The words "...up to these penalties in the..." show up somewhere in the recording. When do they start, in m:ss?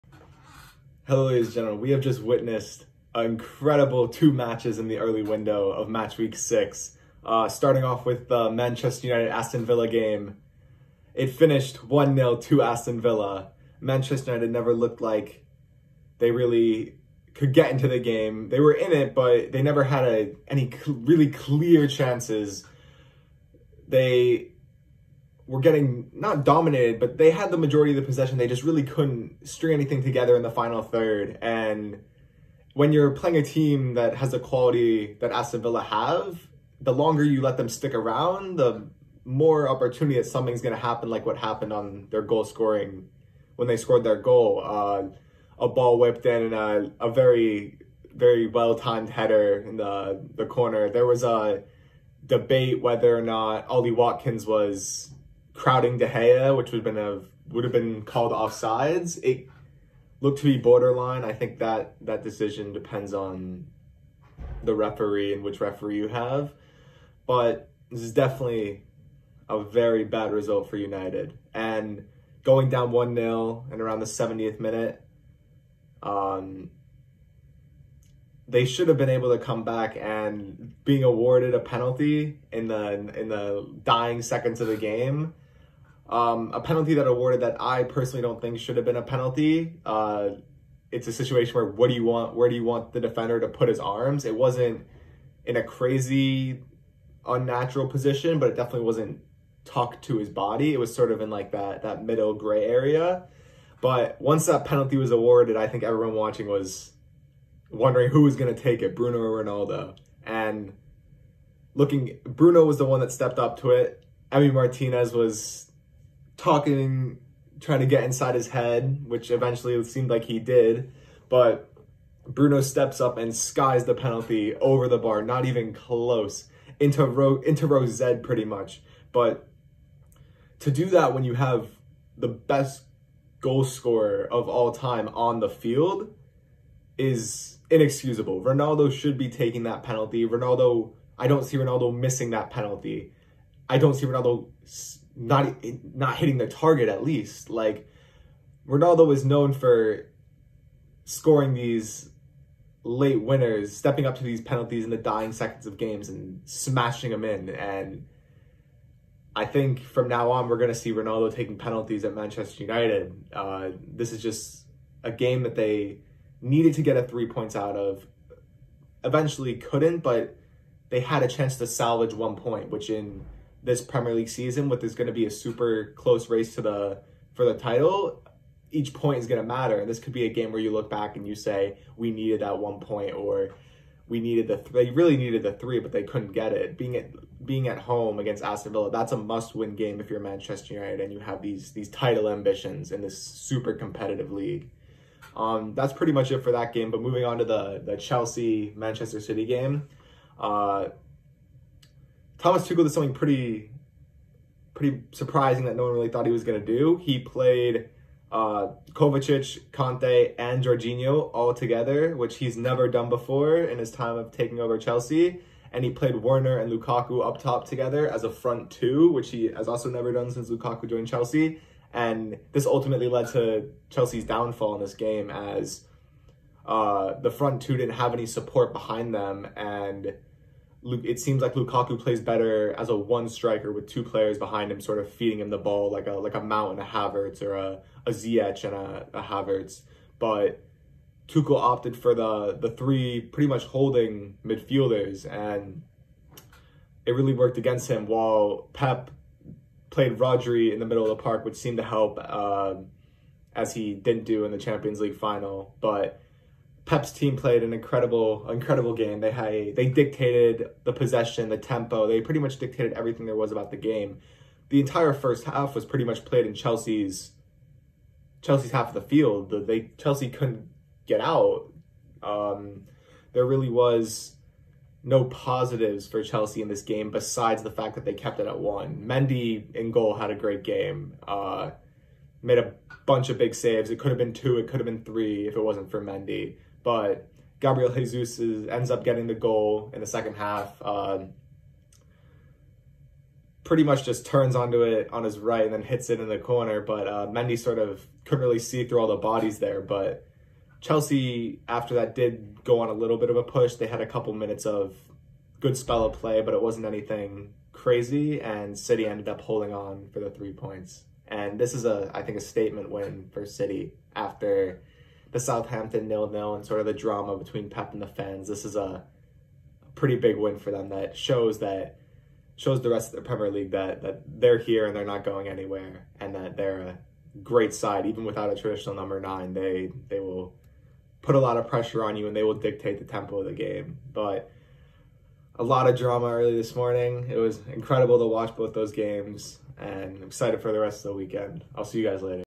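2:34.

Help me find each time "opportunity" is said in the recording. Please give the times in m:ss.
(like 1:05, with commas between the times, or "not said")
0:39.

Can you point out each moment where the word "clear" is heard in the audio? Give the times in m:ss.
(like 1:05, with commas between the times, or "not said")
0:21.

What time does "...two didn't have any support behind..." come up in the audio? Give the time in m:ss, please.
3:47.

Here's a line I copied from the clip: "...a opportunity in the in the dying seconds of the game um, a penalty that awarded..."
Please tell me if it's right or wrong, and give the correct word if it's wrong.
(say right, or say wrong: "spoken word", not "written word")
wrong: "penalty", not "opportunity".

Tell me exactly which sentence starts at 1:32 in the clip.
Where do you want the defender to put his arms?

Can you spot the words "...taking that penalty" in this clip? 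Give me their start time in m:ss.
2:19.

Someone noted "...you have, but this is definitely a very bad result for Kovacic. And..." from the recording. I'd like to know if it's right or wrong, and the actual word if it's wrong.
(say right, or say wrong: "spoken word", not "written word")
wrong: "United", not "Kovacic".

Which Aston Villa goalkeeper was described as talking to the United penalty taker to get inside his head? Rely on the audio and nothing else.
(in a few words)
Emi Martinez.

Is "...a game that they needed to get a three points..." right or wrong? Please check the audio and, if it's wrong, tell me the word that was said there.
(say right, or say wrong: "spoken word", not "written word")
right.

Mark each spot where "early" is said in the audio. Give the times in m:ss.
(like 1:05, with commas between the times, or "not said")
0:04, 5:36.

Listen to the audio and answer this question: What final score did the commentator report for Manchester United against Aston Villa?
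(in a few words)
1-0.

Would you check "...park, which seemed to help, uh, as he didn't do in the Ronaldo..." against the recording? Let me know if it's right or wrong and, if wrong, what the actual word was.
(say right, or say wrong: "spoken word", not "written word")
wrong: "Champions", not "Ronaldo".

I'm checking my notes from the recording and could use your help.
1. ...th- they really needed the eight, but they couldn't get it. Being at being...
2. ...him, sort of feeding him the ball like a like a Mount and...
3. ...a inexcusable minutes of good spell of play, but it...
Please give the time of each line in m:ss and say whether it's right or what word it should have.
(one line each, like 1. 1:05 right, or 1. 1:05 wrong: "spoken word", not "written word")
1. 3:04 wrong: "three", not "eight"
2. 3:54 right
3. 5:04 wrong: "couple", not "inexcusable".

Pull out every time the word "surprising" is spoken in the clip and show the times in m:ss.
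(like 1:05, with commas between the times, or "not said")
3:25.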